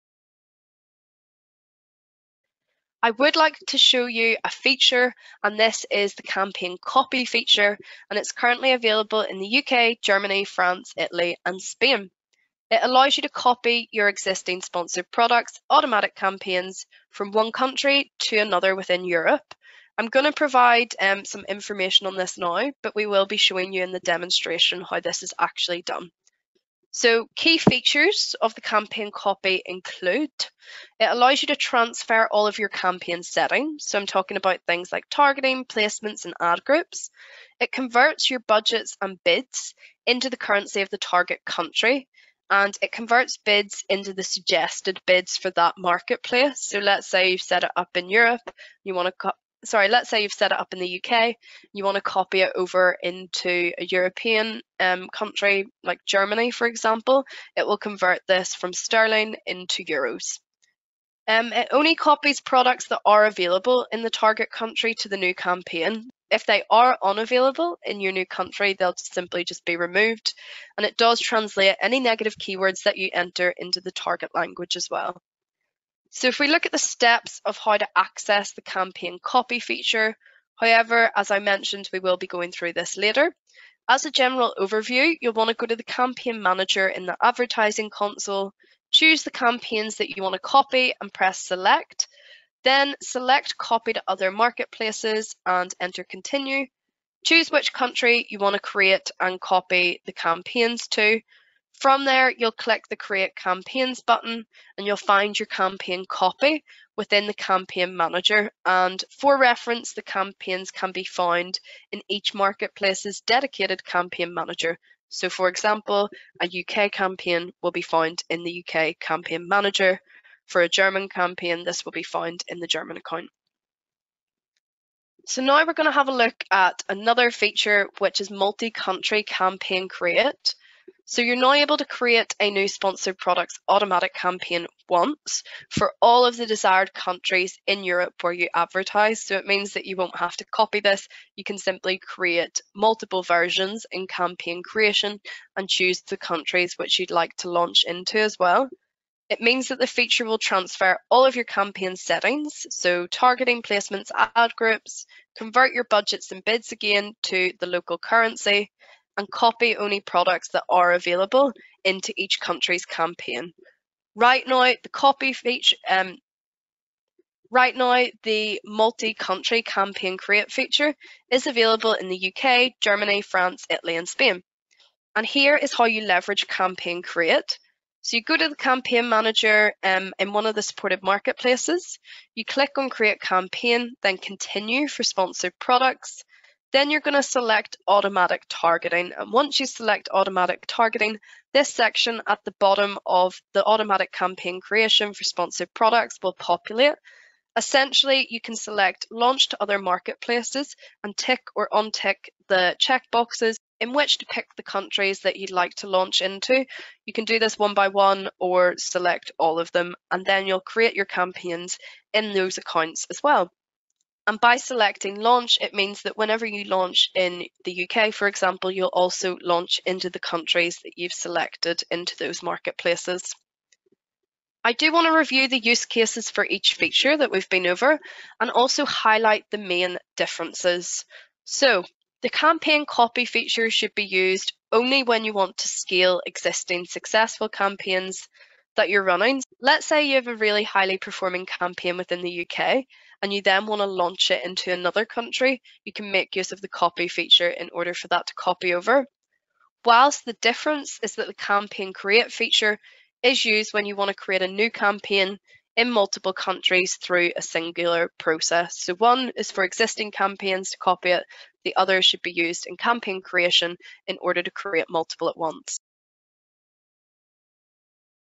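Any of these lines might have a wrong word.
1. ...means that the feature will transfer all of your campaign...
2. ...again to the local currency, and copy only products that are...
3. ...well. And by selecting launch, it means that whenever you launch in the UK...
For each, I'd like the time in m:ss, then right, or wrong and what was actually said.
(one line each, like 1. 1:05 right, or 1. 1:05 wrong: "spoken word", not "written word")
1. 2:29 right
2. 2:36 right
3. 3:33 right.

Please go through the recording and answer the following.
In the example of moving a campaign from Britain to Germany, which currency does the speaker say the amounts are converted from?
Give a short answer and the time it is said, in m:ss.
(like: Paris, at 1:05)
sterling, at 0:58.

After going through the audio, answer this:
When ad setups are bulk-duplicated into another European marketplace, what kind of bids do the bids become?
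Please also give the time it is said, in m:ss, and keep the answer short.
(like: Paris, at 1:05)
suggested bids, at 0:44.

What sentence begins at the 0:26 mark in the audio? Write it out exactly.
So key features of the campaign copy include, it allows you to transfer all of your campaign settings.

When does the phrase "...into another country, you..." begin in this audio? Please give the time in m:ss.
4:04.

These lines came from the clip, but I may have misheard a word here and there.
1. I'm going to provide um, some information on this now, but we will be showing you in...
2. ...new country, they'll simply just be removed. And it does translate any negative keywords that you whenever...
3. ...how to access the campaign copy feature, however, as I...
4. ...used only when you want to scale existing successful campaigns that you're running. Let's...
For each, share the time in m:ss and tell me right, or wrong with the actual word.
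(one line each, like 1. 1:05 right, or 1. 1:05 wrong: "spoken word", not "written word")
1. 0:19 right
2. 1:08 wrong: "enter", not "whenever"
3. 1:17 right
4. 3:54 right.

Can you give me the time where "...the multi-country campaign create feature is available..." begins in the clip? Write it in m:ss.
2:48.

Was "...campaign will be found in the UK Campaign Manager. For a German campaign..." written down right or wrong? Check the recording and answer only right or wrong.
right.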